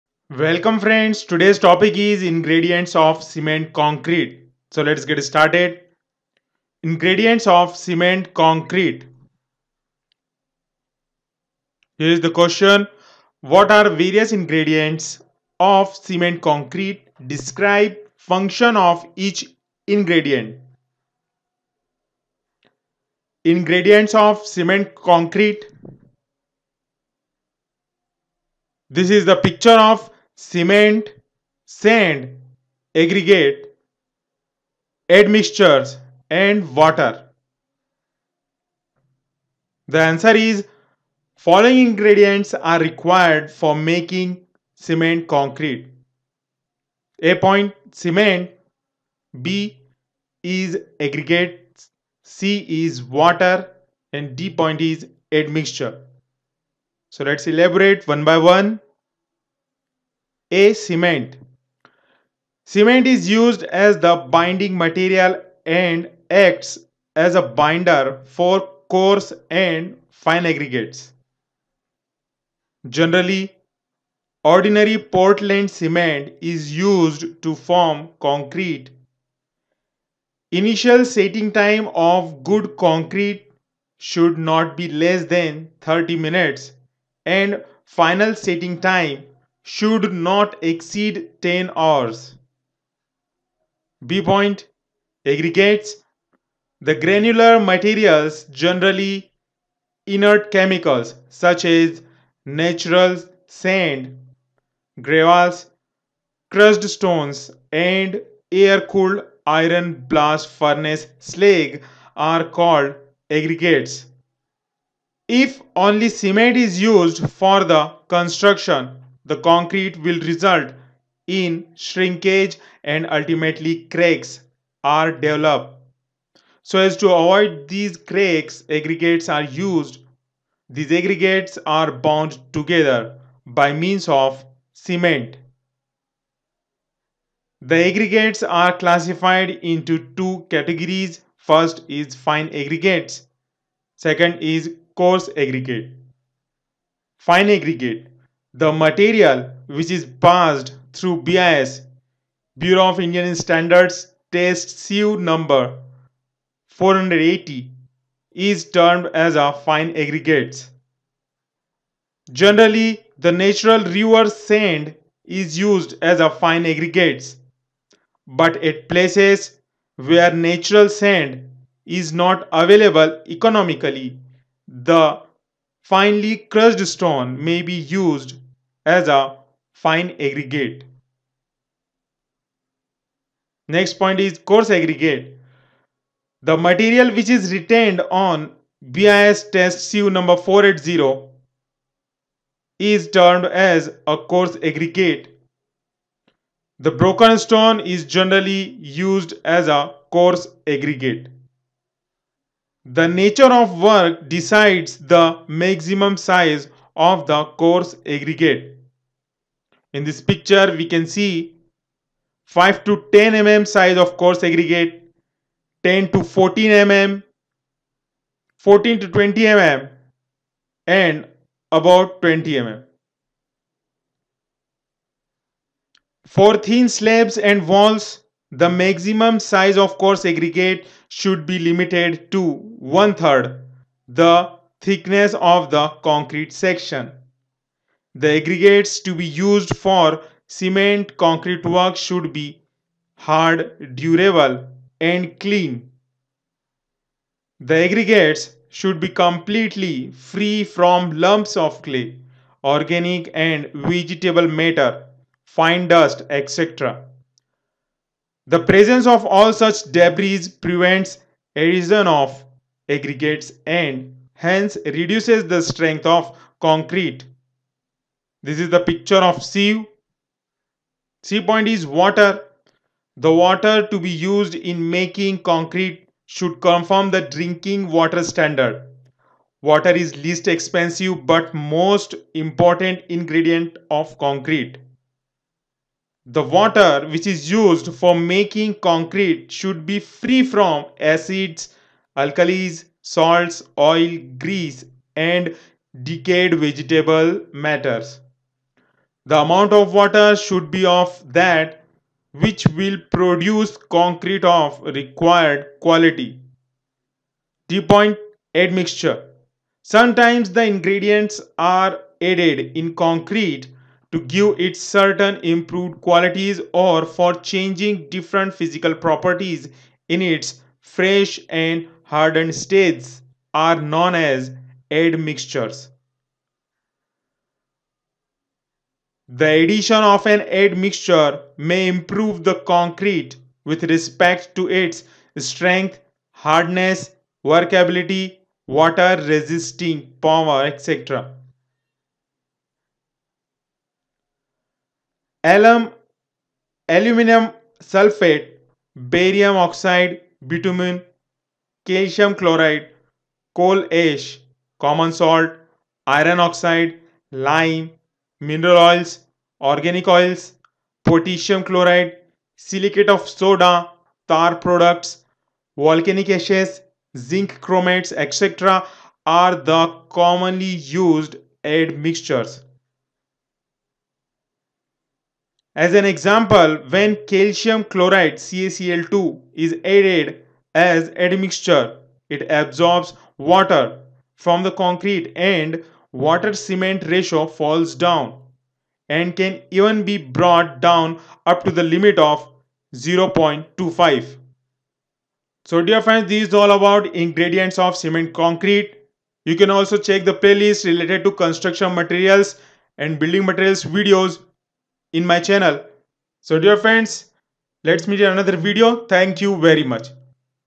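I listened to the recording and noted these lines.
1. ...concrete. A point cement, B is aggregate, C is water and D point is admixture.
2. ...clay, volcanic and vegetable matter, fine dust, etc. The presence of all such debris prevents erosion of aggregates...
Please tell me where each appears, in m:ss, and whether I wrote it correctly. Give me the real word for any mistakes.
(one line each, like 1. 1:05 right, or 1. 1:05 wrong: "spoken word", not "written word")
1. 0:45 right
2. 4:11 wrong: "organic", not "volcanic".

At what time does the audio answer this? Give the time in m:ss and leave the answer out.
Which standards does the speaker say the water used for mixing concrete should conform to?
4:37.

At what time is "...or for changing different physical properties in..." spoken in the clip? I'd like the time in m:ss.
5:16.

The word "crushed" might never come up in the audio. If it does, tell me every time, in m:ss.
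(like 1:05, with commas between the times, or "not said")
1:46, 2:56.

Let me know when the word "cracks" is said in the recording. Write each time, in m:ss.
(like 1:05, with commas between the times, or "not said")
2:03, 2:07.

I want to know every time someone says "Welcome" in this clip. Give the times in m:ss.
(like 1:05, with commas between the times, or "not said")
0:00.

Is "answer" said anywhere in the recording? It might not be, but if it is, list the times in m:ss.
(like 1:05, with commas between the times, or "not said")
0:40.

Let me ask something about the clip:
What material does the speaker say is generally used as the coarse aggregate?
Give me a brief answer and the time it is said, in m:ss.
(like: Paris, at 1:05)
broken stone, at 3:16.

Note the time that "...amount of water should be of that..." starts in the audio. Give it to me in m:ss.
4:59.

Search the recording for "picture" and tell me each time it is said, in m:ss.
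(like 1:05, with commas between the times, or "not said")
0:29, 3:30, 4:28.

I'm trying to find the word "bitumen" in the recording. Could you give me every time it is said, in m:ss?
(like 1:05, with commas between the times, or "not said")
5:50.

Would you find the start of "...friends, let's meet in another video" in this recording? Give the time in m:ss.
6:46.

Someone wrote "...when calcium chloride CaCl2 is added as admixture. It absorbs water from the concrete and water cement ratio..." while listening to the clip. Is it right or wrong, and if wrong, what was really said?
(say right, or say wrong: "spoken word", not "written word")
right.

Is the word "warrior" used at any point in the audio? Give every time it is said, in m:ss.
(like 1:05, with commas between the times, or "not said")
not said.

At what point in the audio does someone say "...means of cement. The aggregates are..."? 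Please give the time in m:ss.
2:13.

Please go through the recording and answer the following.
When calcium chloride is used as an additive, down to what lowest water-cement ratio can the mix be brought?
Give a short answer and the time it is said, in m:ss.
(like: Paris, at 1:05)
0.25, at 6:32.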